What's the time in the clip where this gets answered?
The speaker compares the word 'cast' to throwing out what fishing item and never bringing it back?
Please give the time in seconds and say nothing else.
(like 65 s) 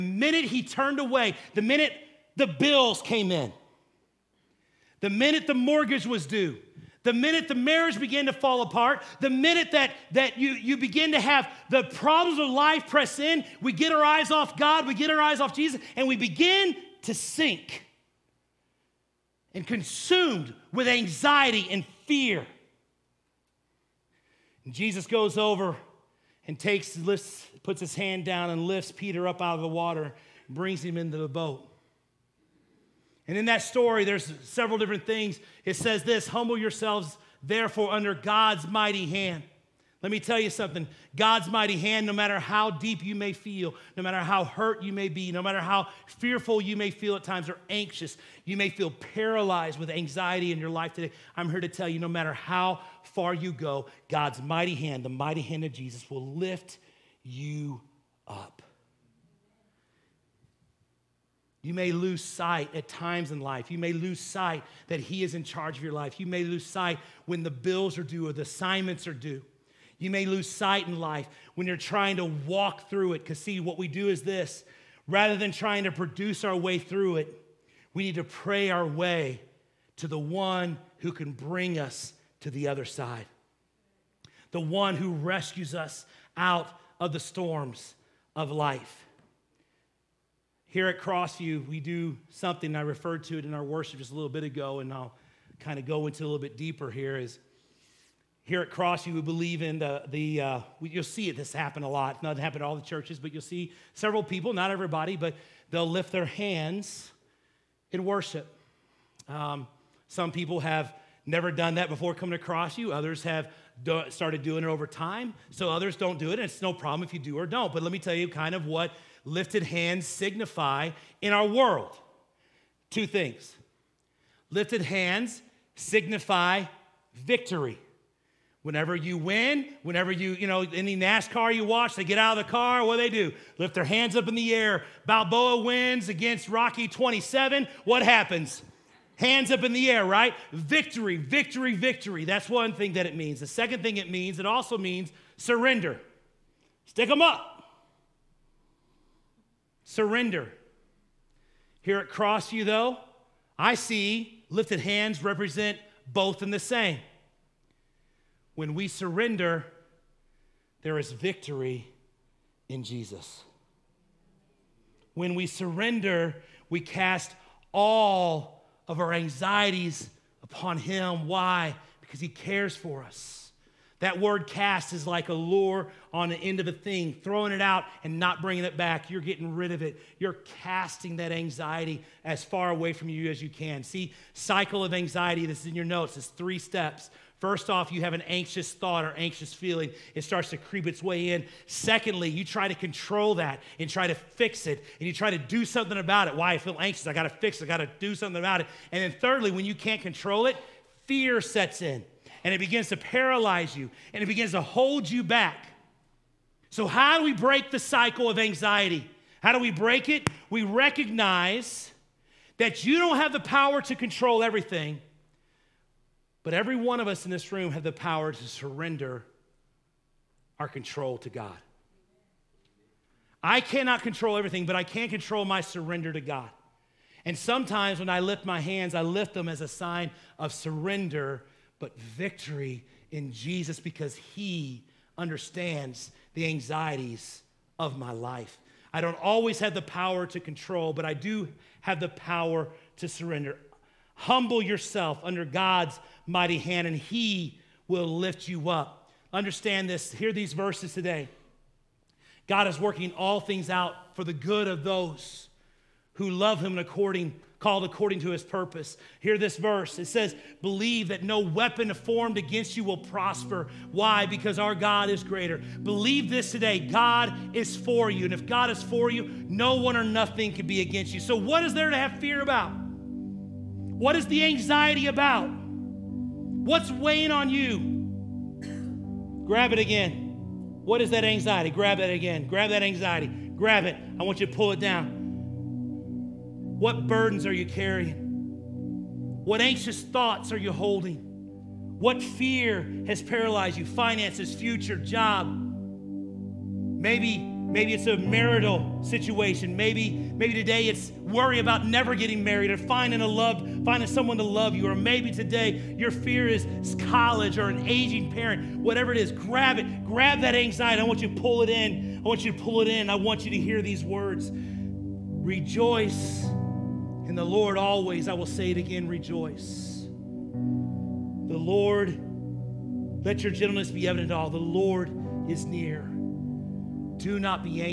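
175 s.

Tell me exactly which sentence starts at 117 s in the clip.
But let me tell you kind of what lifted hands signify in our world.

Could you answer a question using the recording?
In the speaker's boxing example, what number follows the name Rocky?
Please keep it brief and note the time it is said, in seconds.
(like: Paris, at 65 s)
27, at 136 s.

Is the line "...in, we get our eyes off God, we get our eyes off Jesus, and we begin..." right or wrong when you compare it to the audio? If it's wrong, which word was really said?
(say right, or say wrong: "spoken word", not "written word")
right.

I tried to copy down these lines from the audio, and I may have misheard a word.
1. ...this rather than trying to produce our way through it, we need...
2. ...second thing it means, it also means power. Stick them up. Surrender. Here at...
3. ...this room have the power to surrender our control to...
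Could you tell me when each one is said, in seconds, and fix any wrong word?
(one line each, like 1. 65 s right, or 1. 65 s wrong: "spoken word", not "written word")
1. 74 s right
2. 143 s wrong: "surrender", not "power"
3. 217 s right.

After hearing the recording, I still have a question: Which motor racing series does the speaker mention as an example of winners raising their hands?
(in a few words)
NASCAR.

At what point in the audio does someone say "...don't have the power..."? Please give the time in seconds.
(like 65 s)
212 s.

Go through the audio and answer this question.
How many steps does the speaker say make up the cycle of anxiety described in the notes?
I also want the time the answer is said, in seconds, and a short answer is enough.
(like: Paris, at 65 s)
3, at 186 s.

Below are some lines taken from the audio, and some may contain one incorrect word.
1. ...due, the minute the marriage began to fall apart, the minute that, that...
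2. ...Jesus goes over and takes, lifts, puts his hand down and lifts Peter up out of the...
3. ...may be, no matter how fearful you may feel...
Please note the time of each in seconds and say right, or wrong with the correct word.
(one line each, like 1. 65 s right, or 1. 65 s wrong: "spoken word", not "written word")
1. 6 s right
2. 24 s right
3. 44 s right.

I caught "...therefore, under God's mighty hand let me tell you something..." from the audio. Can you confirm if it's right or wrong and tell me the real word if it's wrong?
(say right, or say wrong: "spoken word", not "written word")
right.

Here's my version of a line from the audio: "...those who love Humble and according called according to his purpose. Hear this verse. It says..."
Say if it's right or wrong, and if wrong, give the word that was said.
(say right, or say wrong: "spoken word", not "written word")
wrong: "Him", not "Humble".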